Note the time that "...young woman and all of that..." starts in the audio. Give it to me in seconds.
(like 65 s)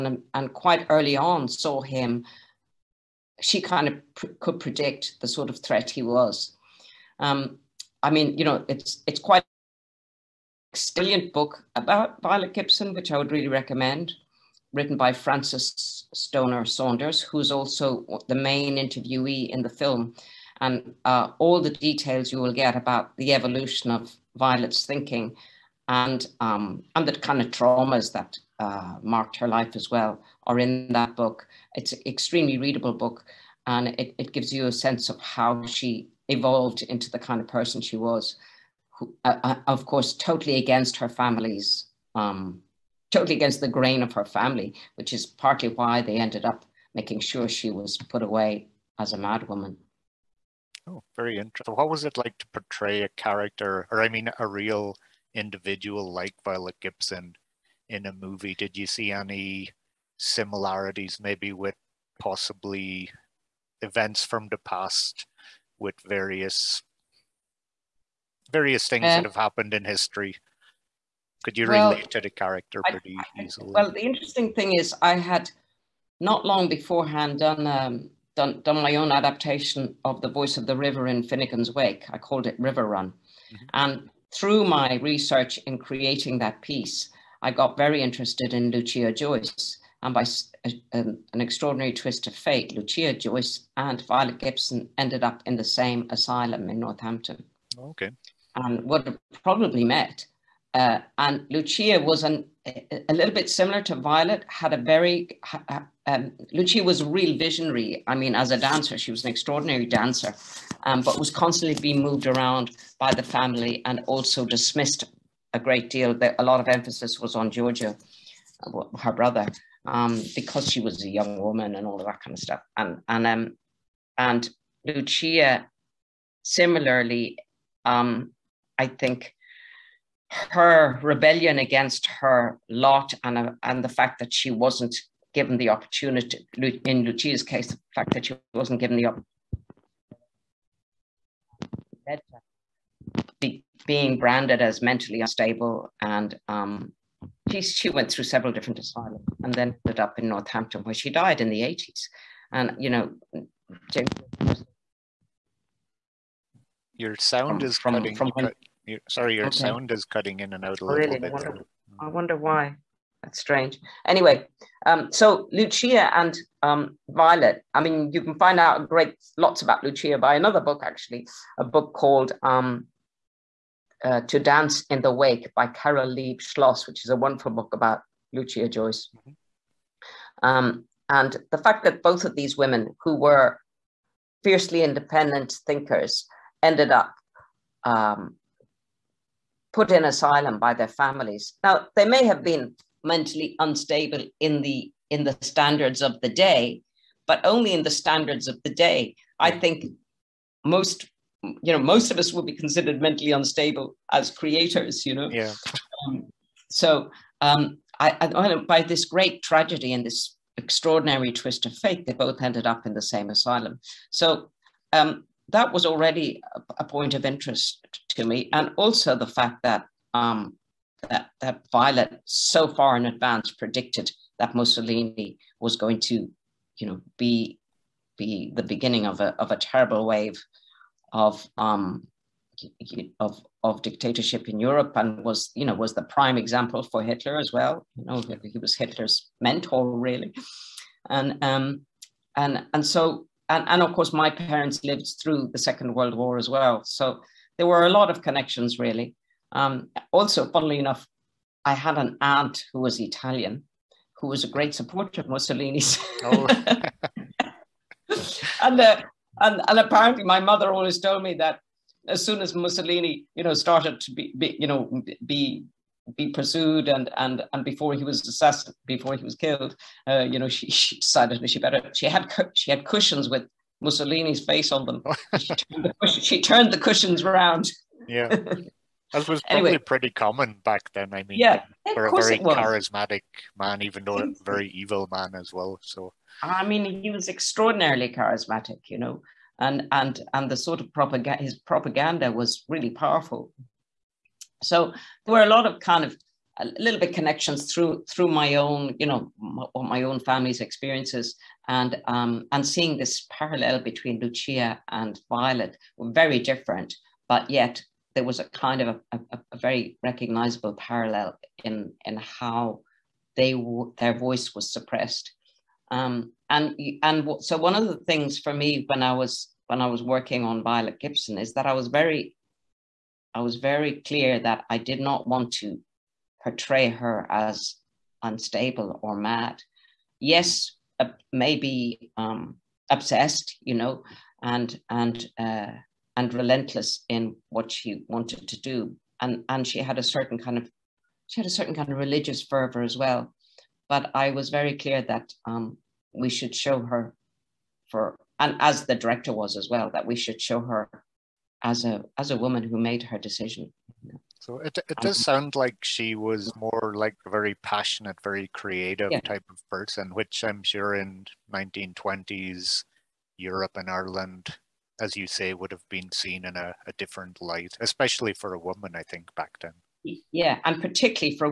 121 s.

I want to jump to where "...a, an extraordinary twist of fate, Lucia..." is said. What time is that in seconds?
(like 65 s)
90 s.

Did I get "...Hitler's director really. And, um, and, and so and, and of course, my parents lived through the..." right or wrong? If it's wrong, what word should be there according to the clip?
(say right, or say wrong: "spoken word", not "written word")
wrong: "mentor", not "director".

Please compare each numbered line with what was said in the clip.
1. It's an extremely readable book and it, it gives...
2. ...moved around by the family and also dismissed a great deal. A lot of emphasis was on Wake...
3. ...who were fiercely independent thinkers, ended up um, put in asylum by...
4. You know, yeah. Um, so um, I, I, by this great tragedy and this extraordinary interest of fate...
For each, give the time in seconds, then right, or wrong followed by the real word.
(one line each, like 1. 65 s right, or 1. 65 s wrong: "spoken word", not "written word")
1. 31 s right
2. 111 s wrong: "Giorgio", not "Wake"
3. 183 s right
4. 205 s wrong: "twist", not "interest".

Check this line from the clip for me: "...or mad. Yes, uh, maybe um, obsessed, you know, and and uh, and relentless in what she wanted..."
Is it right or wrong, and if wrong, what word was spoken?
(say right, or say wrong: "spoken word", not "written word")
right.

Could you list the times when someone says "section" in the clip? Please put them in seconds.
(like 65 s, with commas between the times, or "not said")
not said.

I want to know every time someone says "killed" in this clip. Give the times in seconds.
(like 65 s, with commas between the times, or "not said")
269 s.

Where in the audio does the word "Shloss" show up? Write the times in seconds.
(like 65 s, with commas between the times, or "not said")
176 s.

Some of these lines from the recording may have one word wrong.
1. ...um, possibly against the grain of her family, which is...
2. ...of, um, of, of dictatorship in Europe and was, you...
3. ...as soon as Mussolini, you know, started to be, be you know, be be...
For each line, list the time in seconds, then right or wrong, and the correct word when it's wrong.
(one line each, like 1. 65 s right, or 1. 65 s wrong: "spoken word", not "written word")
1. 42 s wrong: "totally", not "possibly"
2. 231 s right
3. 262 s right.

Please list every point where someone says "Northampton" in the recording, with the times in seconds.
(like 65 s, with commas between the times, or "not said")
96 s, 150 s.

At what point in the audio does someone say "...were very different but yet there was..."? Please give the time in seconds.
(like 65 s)
305 s.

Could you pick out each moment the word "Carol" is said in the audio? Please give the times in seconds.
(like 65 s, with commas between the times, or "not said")
175 s.